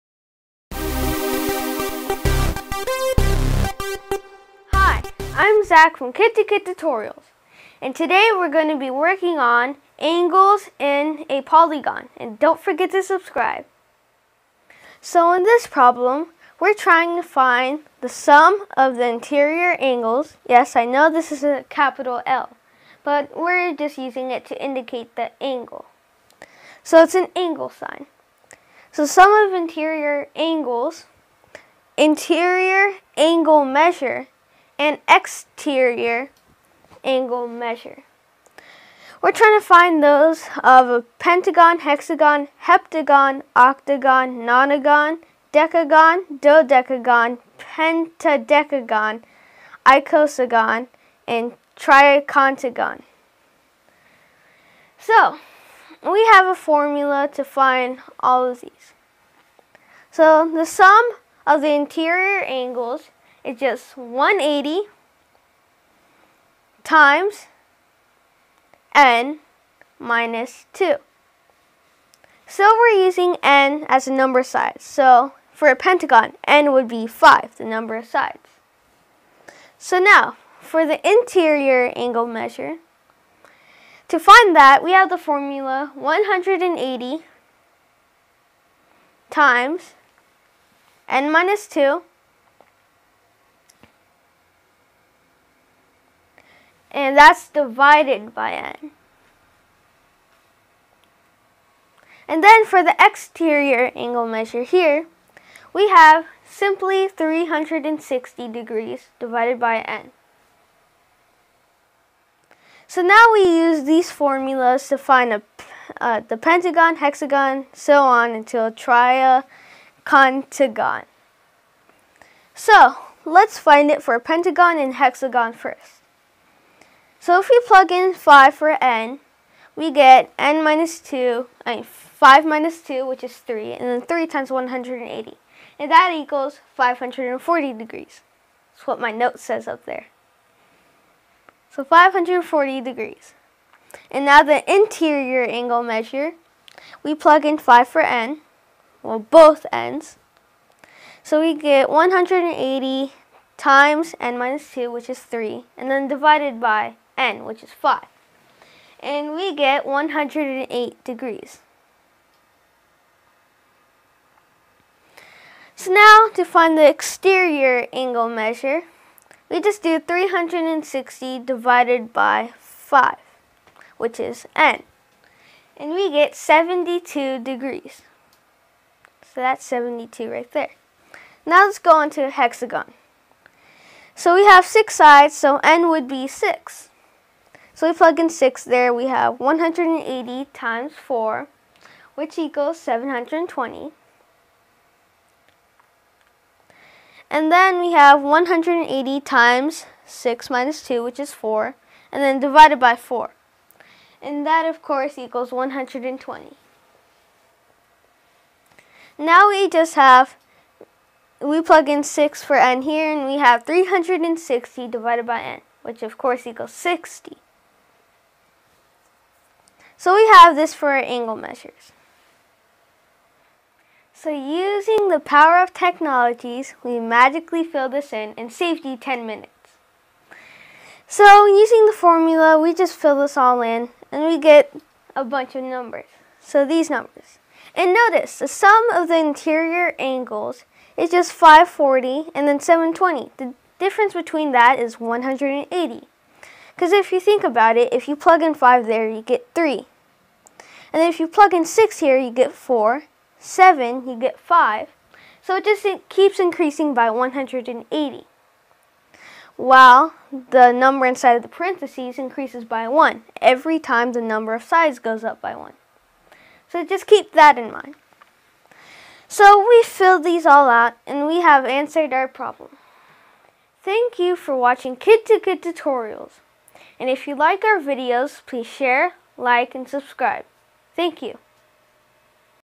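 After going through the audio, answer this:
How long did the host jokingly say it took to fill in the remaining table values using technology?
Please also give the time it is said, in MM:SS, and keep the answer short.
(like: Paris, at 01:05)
10 minutes, at 03:48.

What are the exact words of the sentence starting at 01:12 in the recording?
So we're using n as a number side.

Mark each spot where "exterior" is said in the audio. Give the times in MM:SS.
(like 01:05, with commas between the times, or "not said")
00:35, 01:42, 02:46.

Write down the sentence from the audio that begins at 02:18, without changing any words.
That's what my note says up there.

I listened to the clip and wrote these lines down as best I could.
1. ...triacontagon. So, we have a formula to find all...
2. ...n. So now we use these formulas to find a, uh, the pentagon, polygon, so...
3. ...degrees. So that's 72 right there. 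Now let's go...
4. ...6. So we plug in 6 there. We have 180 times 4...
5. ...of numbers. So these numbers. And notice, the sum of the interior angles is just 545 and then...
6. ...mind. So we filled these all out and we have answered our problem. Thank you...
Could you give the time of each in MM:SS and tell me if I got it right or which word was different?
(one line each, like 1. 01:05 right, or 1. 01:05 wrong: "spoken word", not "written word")
1. 00:51 right
2. 01:49 wrong: "hexagon", not "polygon"
3. 02:57 right
4. 03:06 right
5. 03:55 wrong: "540", not "545"
6. 04:27 right.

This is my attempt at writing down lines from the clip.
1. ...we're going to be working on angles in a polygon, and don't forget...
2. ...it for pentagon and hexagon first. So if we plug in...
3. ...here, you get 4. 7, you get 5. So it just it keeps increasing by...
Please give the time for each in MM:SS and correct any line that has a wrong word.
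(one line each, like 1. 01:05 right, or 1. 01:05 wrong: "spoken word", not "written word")
1. 00:08 right
2. 02:03 right
3. 04:11 right.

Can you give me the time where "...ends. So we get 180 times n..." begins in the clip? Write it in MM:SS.
02:29.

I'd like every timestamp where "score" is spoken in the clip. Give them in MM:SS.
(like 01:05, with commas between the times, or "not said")
not said.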